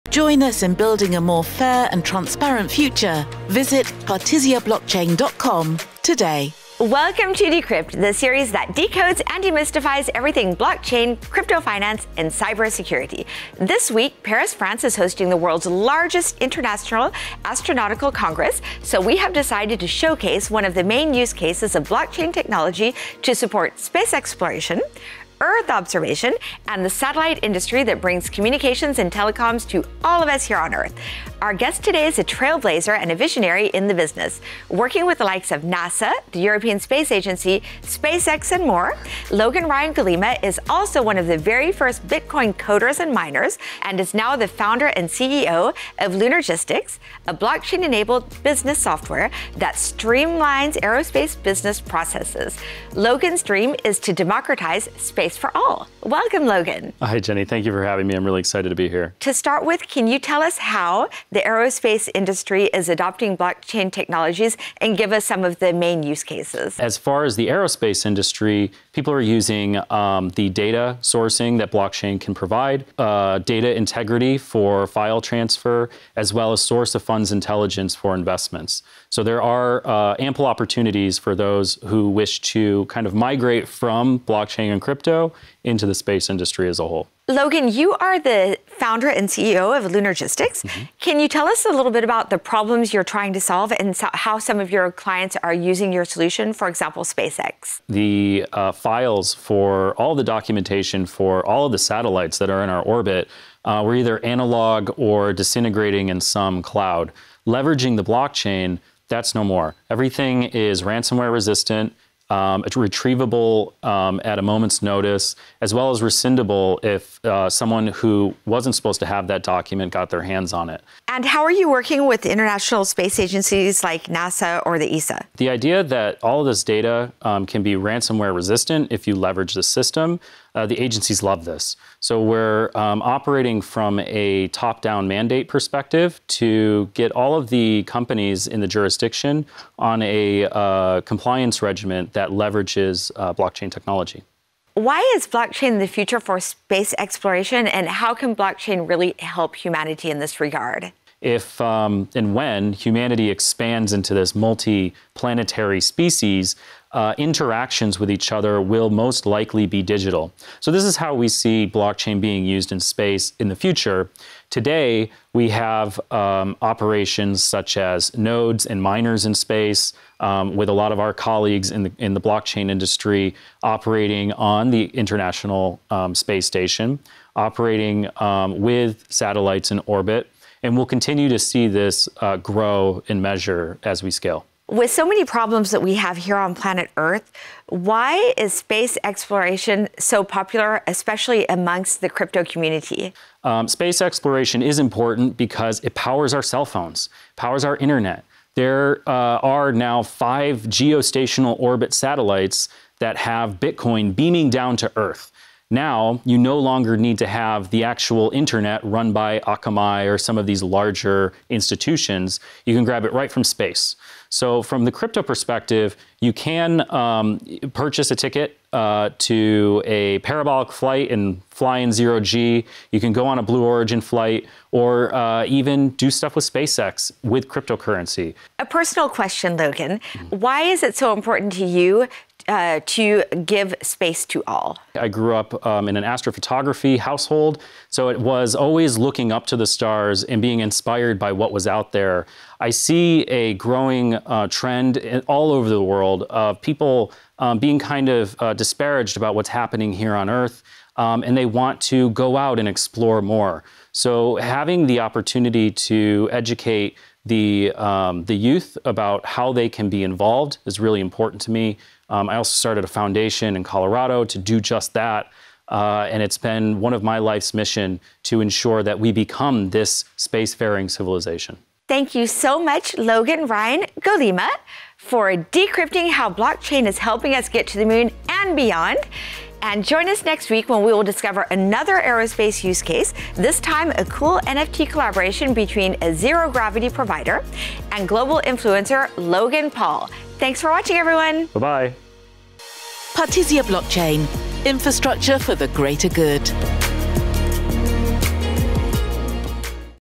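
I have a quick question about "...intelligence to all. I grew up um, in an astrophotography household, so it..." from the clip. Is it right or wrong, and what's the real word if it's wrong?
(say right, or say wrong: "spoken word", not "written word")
wrong: "space", not "intelligence".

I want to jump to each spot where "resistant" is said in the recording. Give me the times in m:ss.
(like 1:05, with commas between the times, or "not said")
1:51, 2:08.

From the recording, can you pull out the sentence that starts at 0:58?
I'm really excited to be here.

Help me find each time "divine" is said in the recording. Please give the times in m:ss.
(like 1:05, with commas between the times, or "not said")
not said.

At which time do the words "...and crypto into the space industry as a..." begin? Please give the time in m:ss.
1:24.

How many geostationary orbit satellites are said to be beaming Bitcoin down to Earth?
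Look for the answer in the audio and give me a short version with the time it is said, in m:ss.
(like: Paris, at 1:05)
5, at 3:20.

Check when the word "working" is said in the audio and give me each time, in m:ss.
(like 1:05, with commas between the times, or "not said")
0:34, 2:01.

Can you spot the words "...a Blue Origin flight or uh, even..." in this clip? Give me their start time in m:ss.
3:43.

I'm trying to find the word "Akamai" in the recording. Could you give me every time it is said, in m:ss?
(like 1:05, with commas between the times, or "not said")
3:29.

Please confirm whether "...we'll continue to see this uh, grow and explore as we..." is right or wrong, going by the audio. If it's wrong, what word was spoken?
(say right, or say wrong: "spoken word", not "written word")
wrong: "measure", not "explore".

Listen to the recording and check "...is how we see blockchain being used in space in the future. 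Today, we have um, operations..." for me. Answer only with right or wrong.
right.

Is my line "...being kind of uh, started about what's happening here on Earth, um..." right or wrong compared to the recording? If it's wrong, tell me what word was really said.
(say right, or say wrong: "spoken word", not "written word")
wrong: "disparaged", not "started".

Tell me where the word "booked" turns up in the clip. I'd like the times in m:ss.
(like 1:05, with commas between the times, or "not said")
not said.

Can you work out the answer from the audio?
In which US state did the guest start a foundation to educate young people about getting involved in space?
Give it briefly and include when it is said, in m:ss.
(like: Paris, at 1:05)
Colorado, at 4:23.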